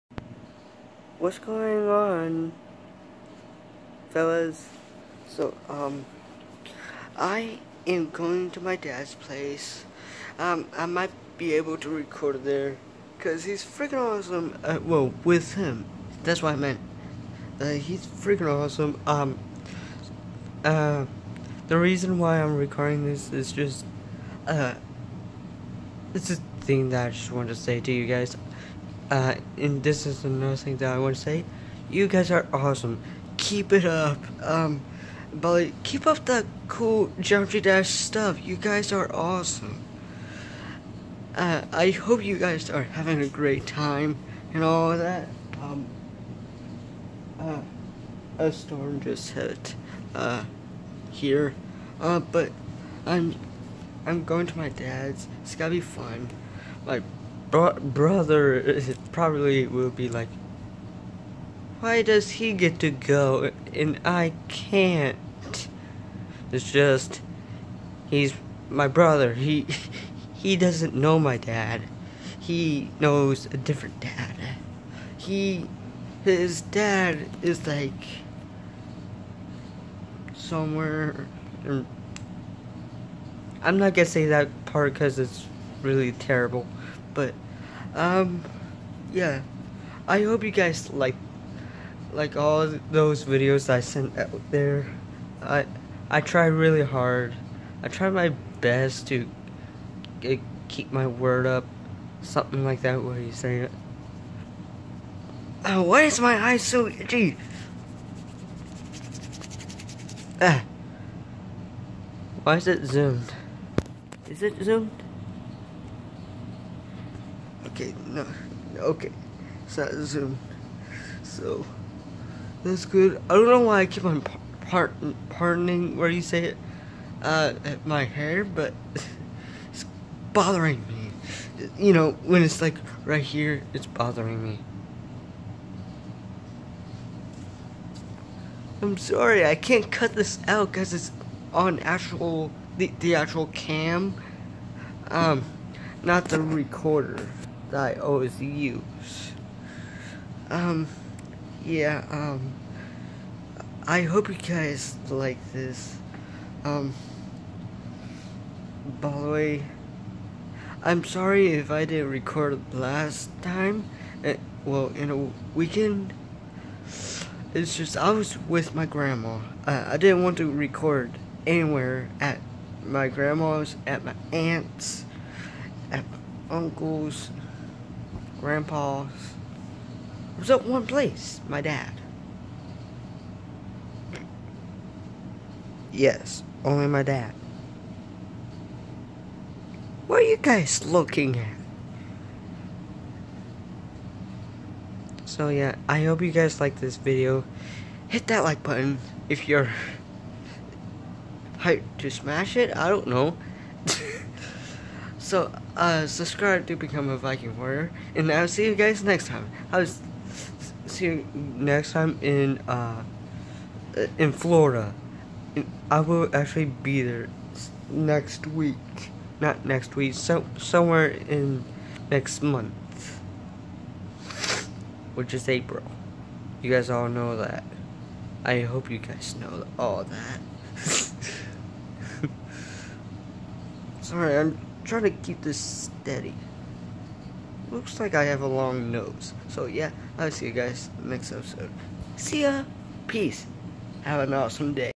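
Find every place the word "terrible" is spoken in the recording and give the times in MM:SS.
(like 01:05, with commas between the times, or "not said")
01:26.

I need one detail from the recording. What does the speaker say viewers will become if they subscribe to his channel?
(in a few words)
Viking warrior.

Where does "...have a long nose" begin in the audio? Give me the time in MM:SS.
03:58.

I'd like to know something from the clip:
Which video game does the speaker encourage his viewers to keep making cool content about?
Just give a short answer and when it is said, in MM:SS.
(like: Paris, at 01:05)
Geometry Dash, at 00:37.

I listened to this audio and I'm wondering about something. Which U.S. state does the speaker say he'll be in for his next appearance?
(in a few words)
Florida.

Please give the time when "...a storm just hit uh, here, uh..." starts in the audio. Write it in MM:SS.
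00:48.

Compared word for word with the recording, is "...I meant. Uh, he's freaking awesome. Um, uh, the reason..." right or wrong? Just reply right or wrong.
right.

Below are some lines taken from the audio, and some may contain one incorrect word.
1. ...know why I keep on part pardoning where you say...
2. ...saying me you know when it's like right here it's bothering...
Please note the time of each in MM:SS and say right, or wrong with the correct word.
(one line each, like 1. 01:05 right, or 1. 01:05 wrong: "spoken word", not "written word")
1. 02:03 right
2. 02:10 wrong: "bothering", not "saying".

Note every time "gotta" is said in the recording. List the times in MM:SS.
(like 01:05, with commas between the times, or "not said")
00:55.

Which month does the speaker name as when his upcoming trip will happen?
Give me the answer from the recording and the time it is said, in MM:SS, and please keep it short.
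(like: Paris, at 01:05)
April, at 03:45.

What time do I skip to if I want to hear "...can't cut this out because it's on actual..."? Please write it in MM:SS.
02:19.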